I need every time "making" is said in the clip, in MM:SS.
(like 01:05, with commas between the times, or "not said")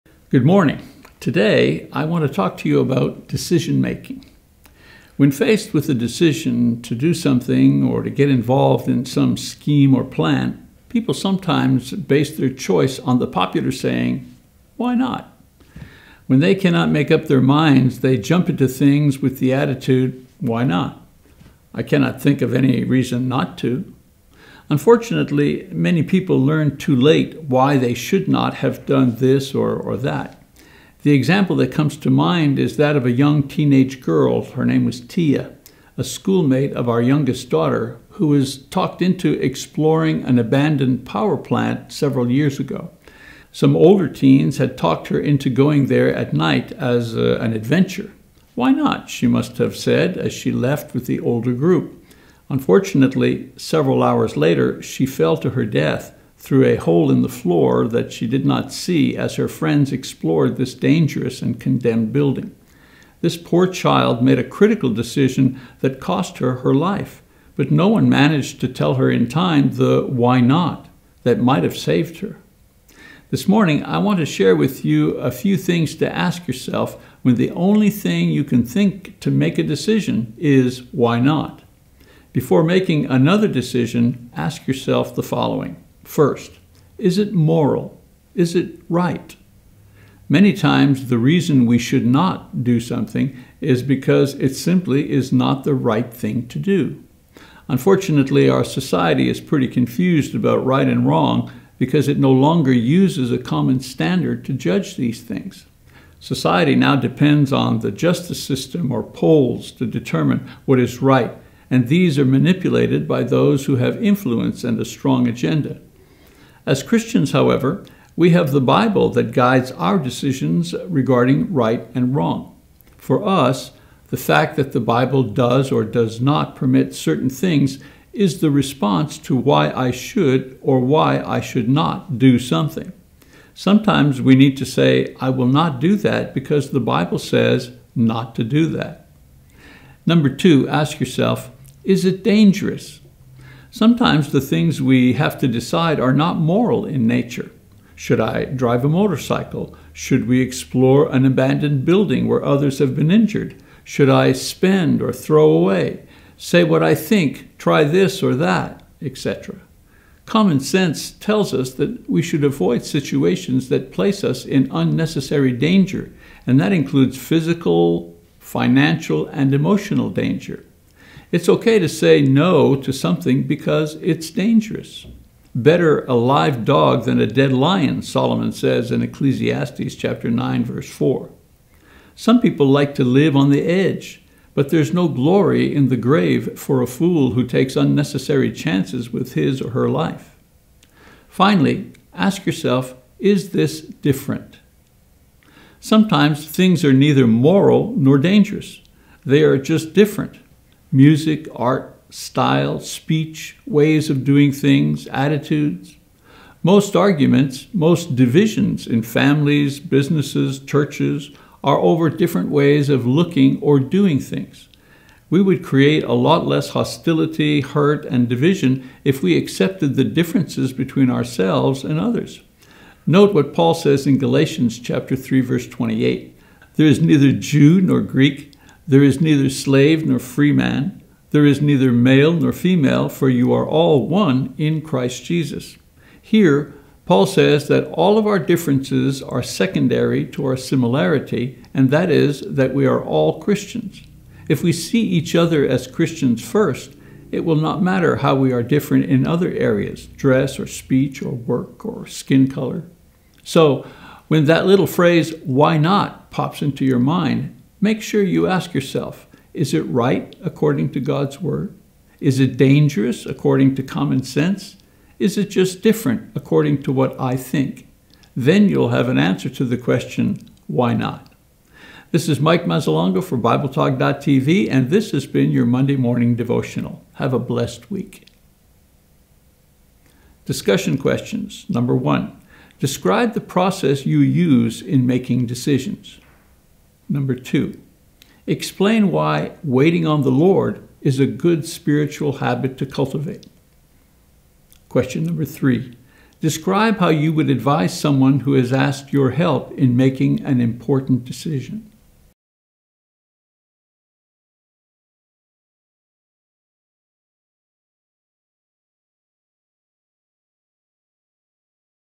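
00:03, 01:22, 04:45, 04:59.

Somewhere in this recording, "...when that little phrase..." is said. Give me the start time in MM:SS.
04:14.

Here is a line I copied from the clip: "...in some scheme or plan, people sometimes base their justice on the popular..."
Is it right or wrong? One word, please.
wrong.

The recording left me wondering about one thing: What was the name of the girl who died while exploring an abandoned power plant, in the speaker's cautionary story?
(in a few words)
Tia.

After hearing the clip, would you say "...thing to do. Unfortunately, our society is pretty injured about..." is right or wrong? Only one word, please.
wrong.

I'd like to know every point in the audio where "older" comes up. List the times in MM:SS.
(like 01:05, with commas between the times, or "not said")
00:43, 00:51.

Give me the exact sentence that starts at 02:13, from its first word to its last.
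Sometimes we need to say, I will not do that because the Bible says not to do that.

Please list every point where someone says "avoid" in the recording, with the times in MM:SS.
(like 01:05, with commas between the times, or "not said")
02:42.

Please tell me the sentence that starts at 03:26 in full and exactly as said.
Most arguments, most divisions in families, businesses, churches are over different ways of looking or doing things.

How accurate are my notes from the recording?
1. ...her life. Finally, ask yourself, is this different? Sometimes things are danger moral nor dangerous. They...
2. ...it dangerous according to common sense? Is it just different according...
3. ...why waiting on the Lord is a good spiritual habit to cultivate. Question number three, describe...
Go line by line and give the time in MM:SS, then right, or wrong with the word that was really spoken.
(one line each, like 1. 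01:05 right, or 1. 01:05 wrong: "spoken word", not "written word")
1. 03:09 wrong: "neither", not "danger"
2. 04:22 right
3. 04:49 right.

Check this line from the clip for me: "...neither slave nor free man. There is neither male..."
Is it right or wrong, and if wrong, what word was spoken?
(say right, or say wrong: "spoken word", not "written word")
right.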